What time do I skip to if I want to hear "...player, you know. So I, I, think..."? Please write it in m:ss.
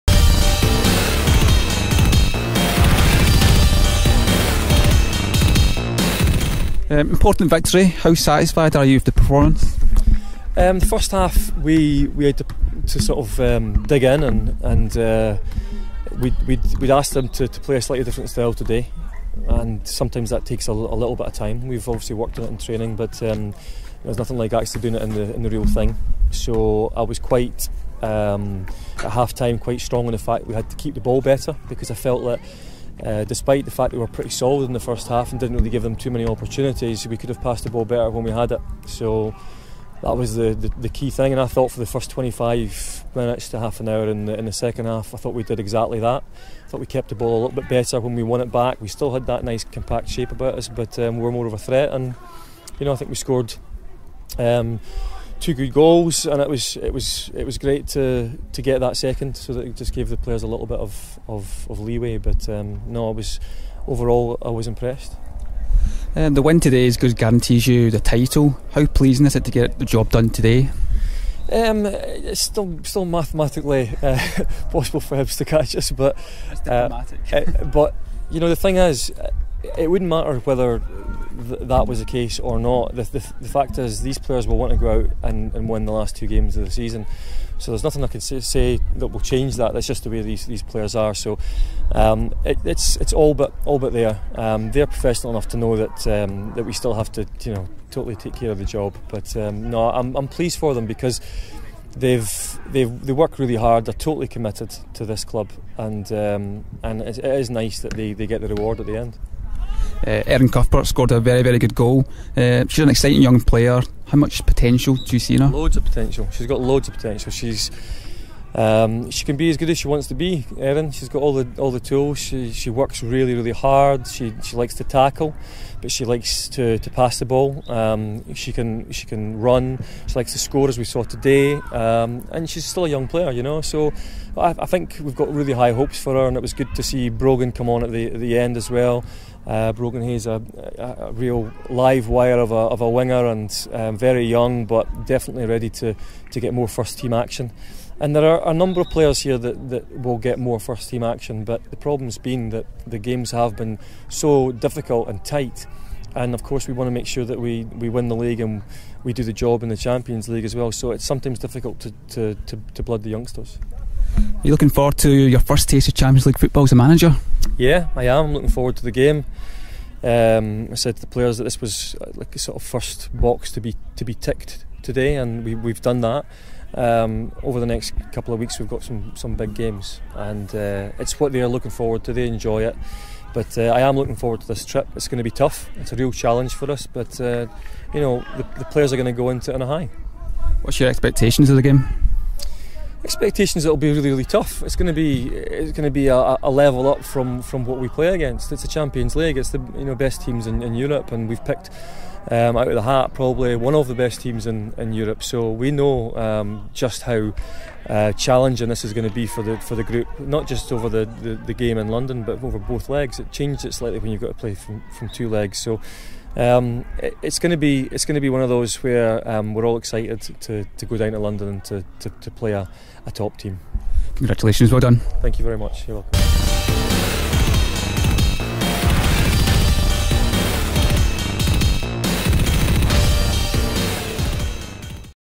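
2:13.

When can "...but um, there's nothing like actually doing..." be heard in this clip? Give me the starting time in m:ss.
0:22.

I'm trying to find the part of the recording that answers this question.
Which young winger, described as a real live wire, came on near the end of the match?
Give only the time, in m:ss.
2:19.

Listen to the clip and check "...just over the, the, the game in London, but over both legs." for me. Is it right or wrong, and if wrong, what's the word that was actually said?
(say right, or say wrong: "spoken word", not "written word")
right.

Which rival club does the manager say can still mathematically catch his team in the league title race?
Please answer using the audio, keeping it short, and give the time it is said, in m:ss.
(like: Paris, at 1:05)
Hibs, at 1:15.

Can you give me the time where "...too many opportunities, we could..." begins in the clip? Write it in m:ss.
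0:35.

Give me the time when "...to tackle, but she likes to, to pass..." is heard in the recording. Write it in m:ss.
2:04.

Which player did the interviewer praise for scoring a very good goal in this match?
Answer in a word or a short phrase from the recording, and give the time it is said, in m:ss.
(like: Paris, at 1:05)
Erin Cuthbert, at 1:50.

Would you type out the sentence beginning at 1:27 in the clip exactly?
So there's nothing I can say, say that will change that.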